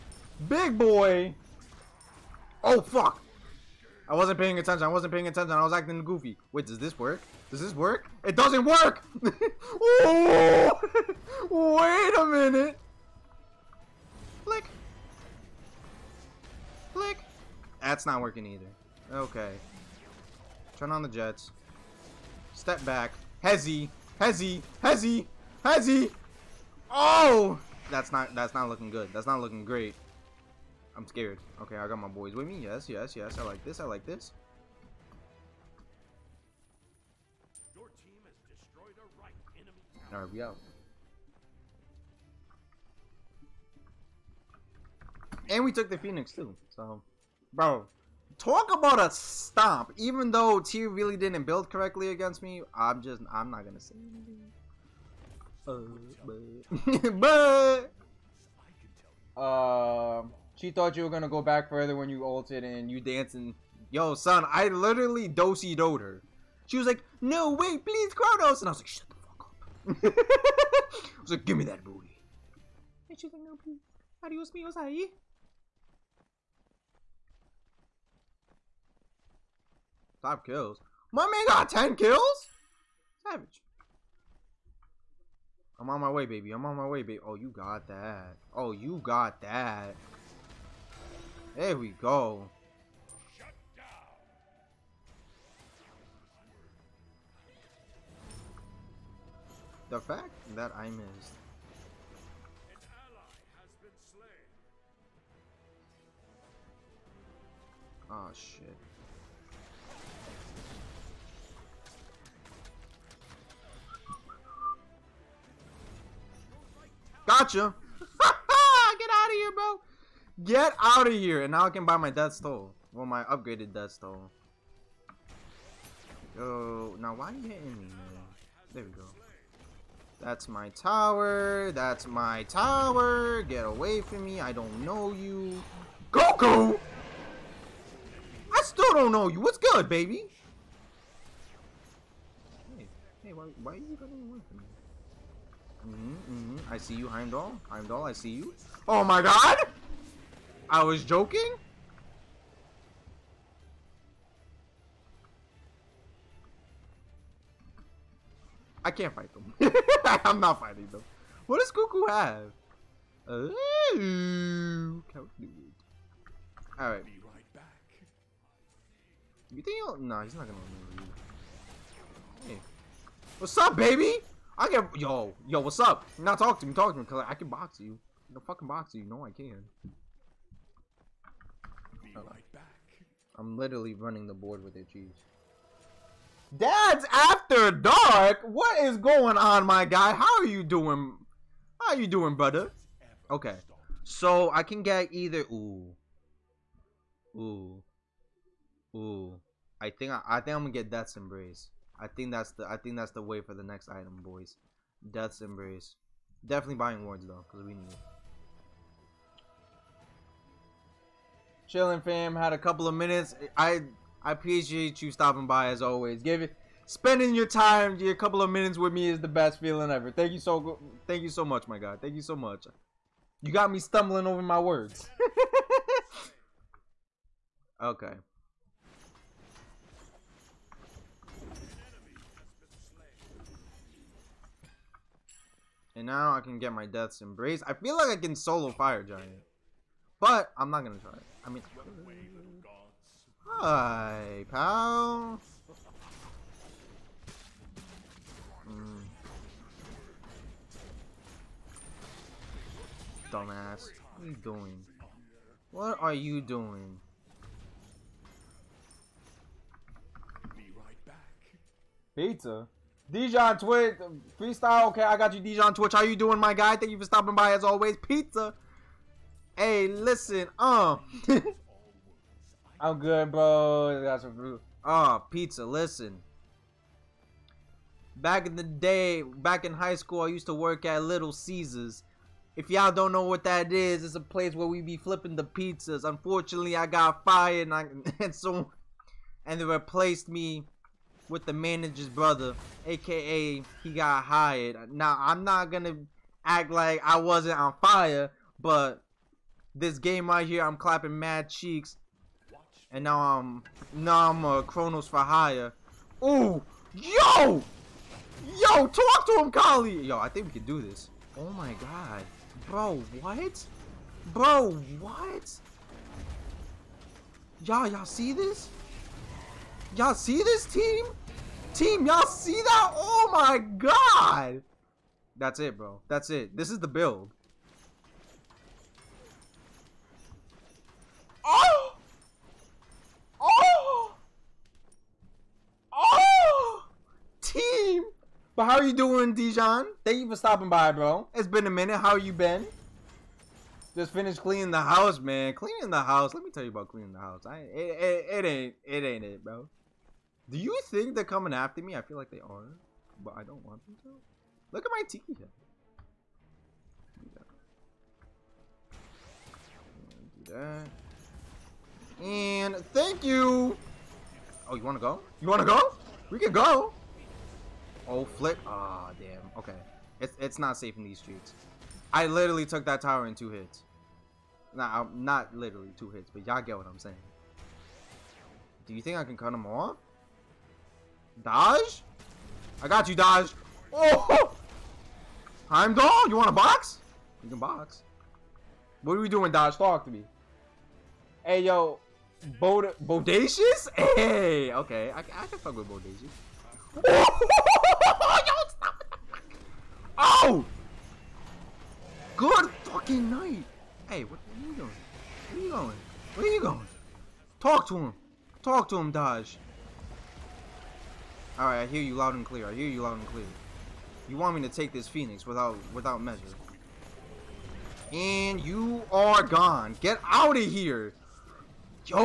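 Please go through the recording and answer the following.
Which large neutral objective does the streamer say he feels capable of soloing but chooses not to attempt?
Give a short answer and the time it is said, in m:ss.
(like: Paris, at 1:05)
Fire Giant, at 3:58.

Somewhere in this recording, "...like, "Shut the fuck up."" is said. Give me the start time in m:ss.
1:08.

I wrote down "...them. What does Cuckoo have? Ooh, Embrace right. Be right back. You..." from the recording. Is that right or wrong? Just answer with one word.
wrong.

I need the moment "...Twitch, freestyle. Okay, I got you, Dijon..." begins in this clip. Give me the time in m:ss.
4:23.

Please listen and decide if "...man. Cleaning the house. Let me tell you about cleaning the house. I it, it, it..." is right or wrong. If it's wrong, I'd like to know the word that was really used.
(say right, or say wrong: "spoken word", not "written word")
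right.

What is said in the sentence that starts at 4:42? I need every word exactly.
If y'all don't know what that is, it's a place where we be flipping the pizzas.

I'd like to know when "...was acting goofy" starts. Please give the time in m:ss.
0:05.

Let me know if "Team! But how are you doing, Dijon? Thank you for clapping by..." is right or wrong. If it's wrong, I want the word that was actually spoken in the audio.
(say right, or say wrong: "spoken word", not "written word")
wrong: "stopping", not "clapping".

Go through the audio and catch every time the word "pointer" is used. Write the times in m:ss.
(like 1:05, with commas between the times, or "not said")
not said.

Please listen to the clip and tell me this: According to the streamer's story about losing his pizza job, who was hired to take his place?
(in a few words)
the manager's brother.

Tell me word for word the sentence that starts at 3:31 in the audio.
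Chilling fam, had a couple of minutes.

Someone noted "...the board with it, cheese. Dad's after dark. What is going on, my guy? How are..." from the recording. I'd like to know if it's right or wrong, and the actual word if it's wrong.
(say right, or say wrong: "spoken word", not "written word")
right.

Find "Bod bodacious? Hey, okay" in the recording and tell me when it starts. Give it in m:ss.
6:32.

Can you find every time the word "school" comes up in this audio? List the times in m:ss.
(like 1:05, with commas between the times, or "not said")
4:39.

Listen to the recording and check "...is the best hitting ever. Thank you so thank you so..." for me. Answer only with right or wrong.
wrong.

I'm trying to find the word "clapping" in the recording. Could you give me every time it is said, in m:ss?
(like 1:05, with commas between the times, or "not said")
5:00.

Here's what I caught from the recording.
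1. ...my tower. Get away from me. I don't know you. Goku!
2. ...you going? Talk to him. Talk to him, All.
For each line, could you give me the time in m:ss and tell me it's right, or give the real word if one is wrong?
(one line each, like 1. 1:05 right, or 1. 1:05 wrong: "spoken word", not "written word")
1. 2:12 right
2. 6:46 wrong: "Dodge", not "All".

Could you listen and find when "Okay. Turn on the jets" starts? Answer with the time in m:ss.
0:19.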